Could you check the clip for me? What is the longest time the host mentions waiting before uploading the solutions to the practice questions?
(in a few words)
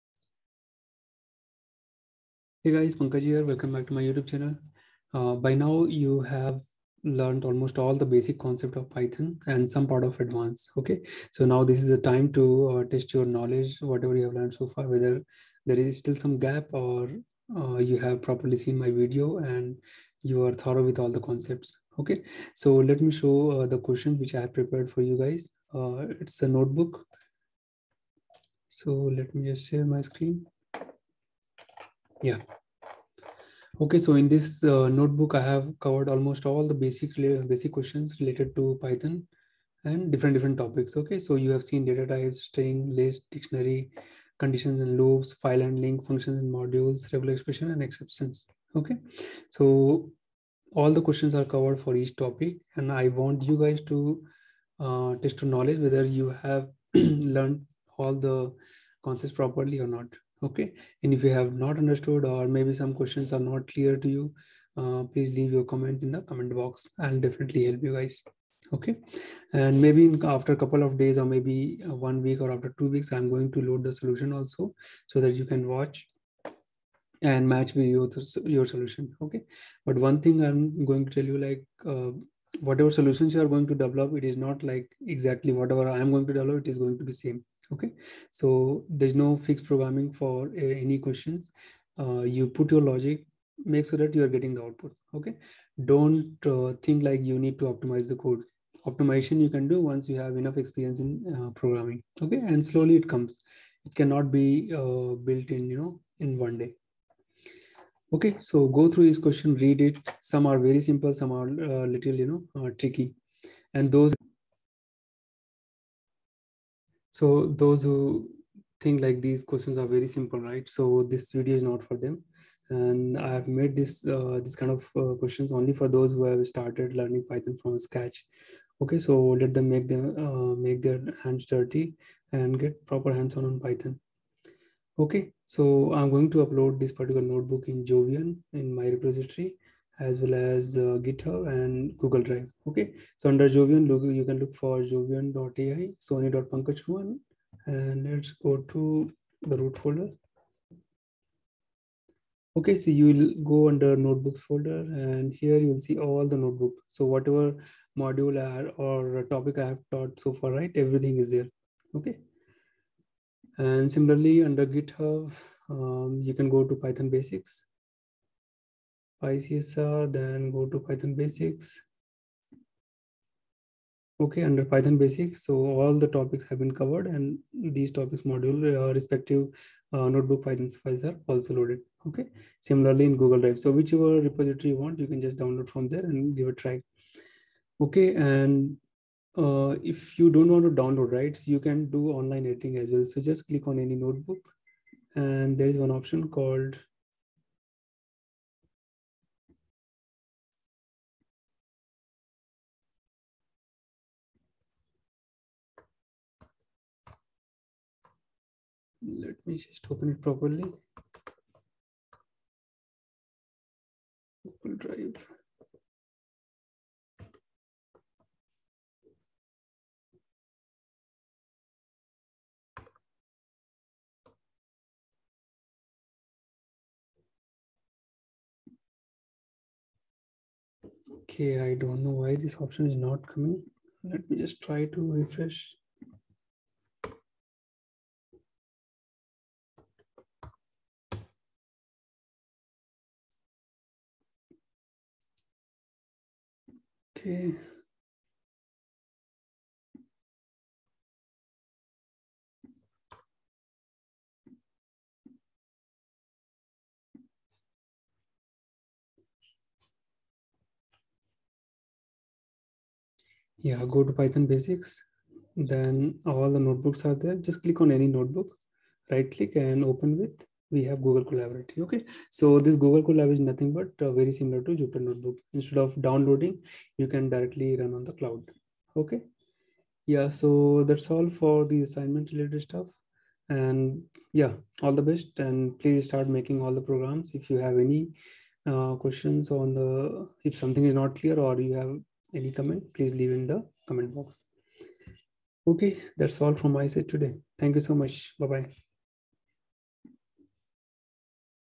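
Two weeks.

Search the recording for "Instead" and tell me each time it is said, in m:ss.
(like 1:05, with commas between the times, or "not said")
4:35.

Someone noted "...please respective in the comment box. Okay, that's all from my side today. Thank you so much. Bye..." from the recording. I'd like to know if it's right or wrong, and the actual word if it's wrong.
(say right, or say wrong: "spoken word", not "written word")
wrong: "leave", not "respective".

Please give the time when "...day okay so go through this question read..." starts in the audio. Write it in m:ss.
1:46.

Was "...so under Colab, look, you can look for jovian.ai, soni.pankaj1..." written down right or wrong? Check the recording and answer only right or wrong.
wrong.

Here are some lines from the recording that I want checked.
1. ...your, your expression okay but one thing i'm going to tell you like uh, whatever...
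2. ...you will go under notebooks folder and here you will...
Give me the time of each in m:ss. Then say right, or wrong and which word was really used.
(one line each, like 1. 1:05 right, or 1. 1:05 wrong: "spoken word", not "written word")
1. 1:17 wrong: "solution", not "expression"
2. 2:32 right.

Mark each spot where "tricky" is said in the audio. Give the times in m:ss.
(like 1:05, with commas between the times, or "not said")
1:52.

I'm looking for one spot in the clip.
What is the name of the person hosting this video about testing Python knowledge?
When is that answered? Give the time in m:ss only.
0:02.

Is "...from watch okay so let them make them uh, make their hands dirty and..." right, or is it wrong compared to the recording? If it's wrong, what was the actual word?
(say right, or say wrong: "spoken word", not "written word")
wrong: "scratch", not "watch".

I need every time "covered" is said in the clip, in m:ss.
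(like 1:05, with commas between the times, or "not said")
0:35, 0:51, 2:56.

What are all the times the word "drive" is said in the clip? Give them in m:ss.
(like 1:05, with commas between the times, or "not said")
2:22, 3:03, 3:34.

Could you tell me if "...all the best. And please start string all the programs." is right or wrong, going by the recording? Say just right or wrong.
wrong.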